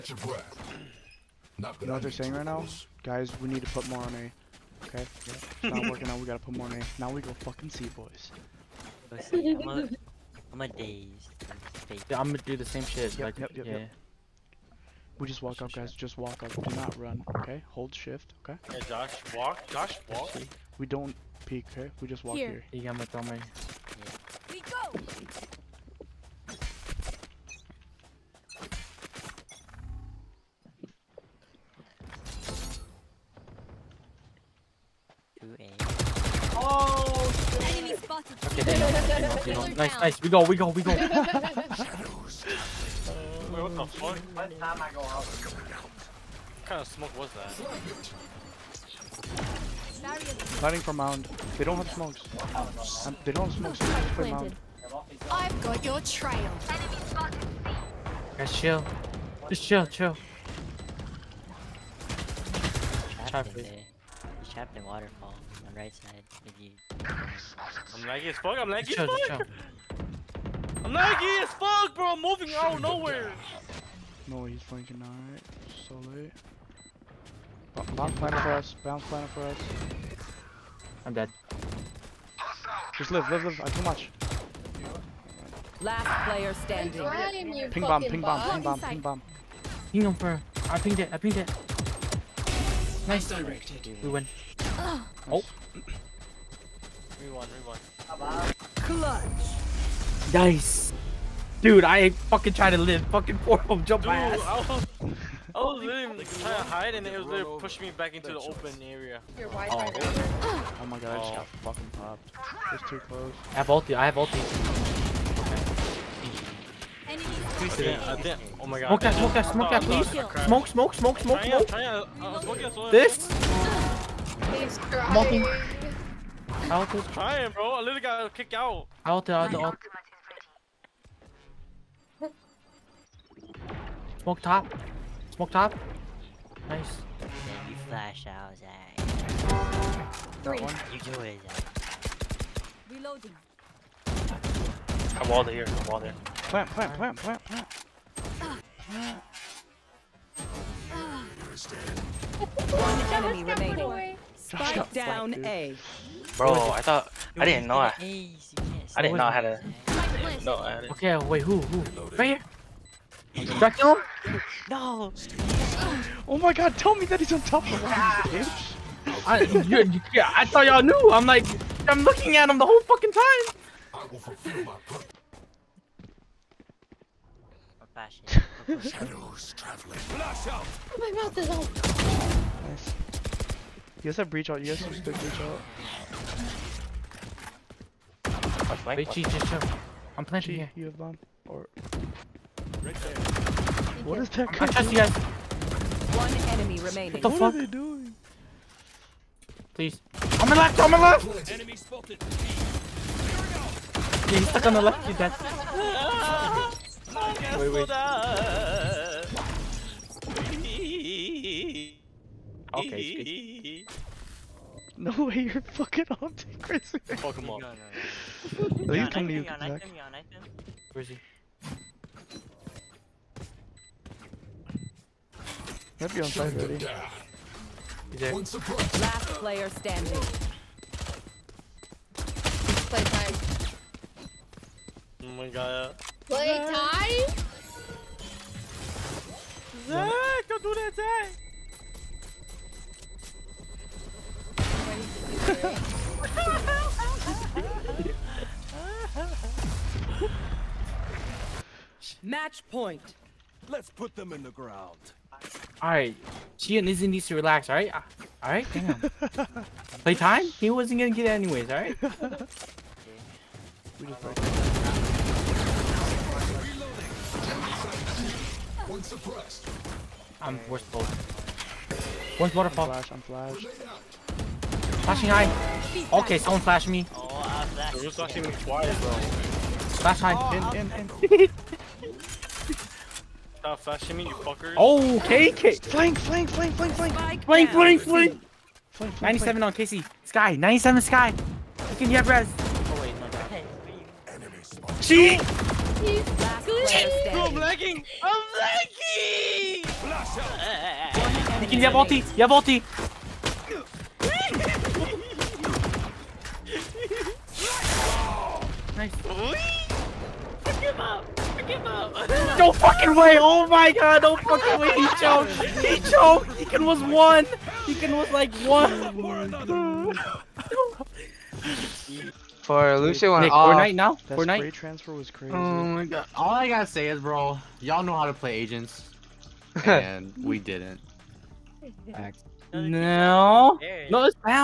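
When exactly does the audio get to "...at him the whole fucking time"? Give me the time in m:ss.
2:52.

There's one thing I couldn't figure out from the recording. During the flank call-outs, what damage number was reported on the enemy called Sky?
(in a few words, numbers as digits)
97.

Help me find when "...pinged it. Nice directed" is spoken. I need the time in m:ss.
1:31.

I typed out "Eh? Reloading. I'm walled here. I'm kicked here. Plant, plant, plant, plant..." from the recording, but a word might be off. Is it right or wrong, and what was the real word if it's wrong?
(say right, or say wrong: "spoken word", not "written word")
wrong: "walled", not "kicked".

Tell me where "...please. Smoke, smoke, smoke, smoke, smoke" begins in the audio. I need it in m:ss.
1:59.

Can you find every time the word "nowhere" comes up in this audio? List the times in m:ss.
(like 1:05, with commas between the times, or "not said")
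1:12.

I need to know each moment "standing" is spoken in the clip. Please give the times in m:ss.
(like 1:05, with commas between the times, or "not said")
1:26, 3:49.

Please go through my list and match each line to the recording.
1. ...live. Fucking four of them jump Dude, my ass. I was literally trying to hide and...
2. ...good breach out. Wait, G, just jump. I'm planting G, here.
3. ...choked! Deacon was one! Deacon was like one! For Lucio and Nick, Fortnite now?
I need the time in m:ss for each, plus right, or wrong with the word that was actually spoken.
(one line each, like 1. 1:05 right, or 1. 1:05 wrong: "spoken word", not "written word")
1. 1:42 right
2. 3:05 right
3. 5:16 right.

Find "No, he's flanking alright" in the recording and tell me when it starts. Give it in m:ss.
1:14.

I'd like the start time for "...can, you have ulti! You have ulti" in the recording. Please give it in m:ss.
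5:01.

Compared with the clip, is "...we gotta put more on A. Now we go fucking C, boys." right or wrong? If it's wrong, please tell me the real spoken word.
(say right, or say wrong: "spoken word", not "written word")
right.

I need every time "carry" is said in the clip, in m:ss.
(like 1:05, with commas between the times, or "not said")
not said.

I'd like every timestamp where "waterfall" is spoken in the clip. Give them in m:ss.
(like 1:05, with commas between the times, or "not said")
1:04, 4:32.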